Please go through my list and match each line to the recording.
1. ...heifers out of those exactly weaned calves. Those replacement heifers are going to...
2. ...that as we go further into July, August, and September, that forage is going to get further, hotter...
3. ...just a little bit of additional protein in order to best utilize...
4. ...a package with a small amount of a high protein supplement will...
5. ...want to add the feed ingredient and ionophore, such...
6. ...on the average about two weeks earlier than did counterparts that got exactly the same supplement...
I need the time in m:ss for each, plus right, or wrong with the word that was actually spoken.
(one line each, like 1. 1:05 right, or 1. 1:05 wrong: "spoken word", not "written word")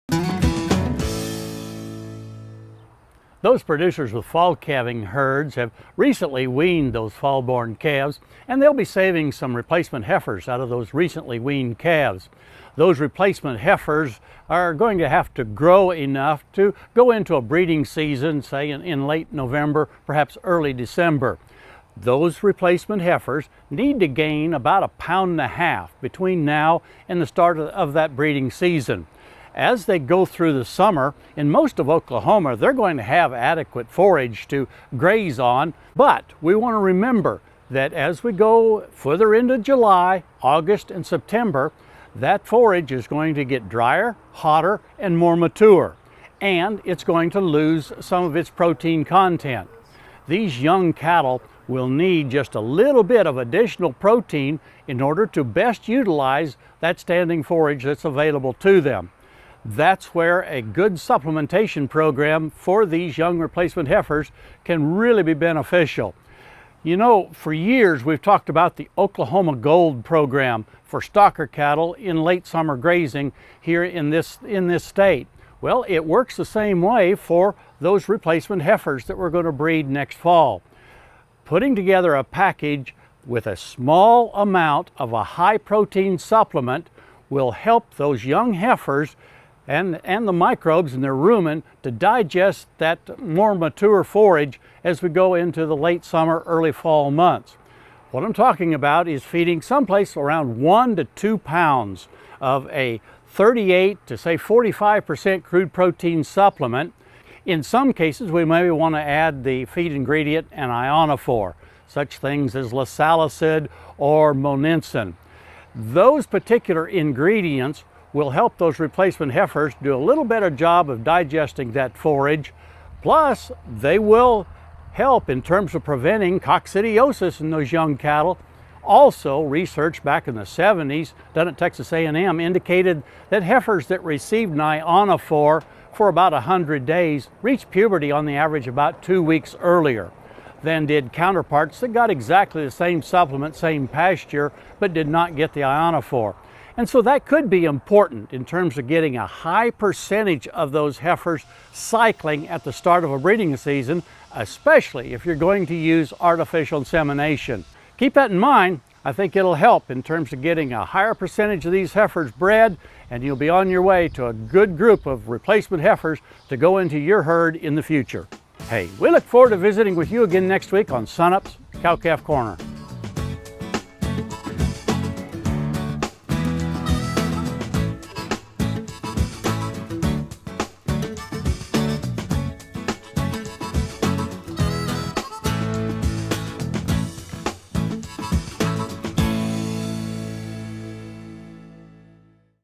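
1. 0:10 wrong: "recently", not "exactly"
2. 0:37 wrong: "drier", not "further"
3. 0:52 right
4. 1:22 right
5. 1:48 right
6. 2:18 right.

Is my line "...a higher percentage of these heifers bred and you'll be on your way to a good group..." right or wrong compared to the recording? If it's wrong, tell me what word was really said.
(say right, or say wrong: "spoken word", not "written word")
right.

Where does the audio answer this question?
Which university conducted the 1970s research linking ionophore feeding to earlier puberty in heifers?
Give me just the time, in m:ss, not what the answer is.
2:11.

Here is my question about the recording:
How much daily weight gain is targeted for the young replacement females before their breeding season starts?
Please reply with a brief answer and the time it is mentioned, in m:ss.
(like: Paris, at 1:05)
1.5 pounds, at 0:24.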